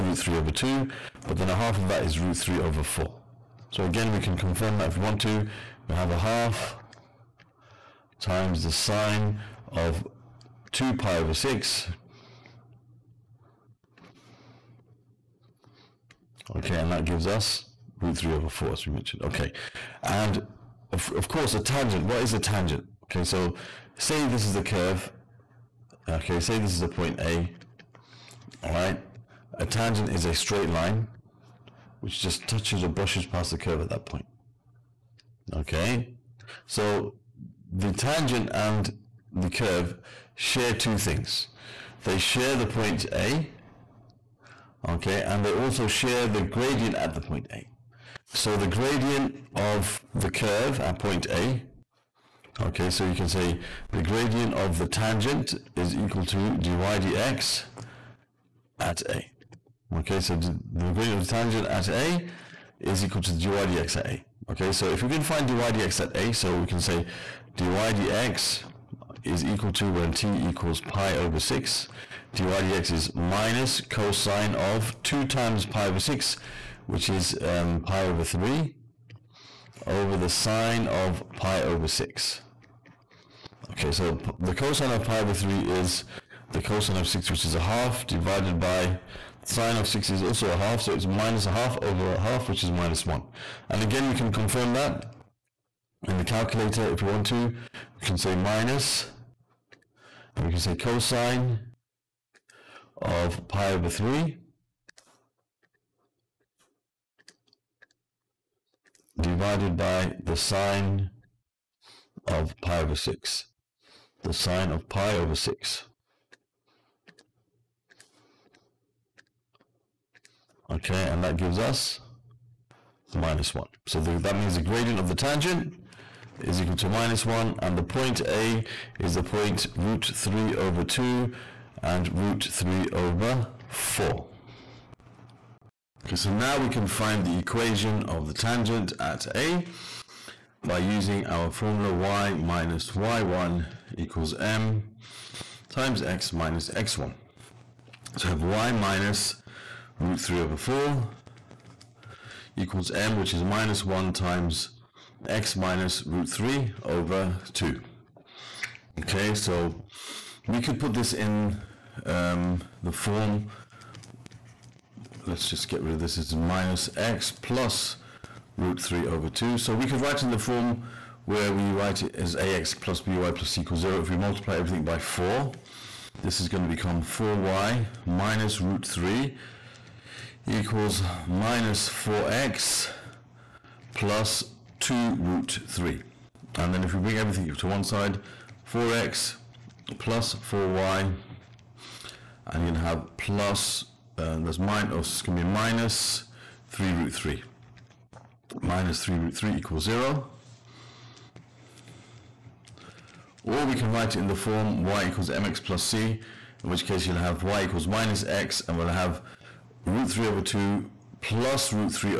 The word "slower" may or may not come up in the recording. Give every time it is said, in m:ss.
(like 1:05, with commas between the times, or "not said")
not said.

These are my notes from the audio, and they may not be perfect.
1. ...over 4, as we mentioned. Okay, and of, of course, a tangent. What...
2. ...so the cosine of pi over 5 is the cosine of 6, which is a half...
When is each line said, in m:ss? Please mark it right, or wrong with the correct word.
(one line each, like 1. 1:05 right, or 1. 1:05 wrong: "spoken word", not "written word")
1. 0:18 right
2. 1:23 wrong: "3", not "5".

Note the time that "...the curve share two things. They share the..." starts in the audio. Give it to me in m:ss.
0:39.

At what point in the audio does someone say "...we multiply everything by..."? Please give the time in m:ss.
2:54.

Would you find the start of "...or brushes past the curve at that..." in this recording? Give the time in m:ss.
0:32.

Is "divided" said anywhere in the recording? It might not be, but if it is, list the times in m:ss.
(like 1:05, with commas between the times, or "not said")
1:28, 1:49.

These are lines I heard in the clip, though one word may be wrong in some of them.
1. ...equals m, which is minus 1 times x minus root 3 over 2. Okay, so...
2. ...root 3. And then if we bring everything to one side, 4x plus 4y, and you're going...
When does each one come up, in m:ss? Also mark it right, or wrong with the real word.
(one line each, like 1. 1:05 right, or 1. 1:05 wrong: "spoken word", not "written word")
1. 2:32 right
2. 3:05 right.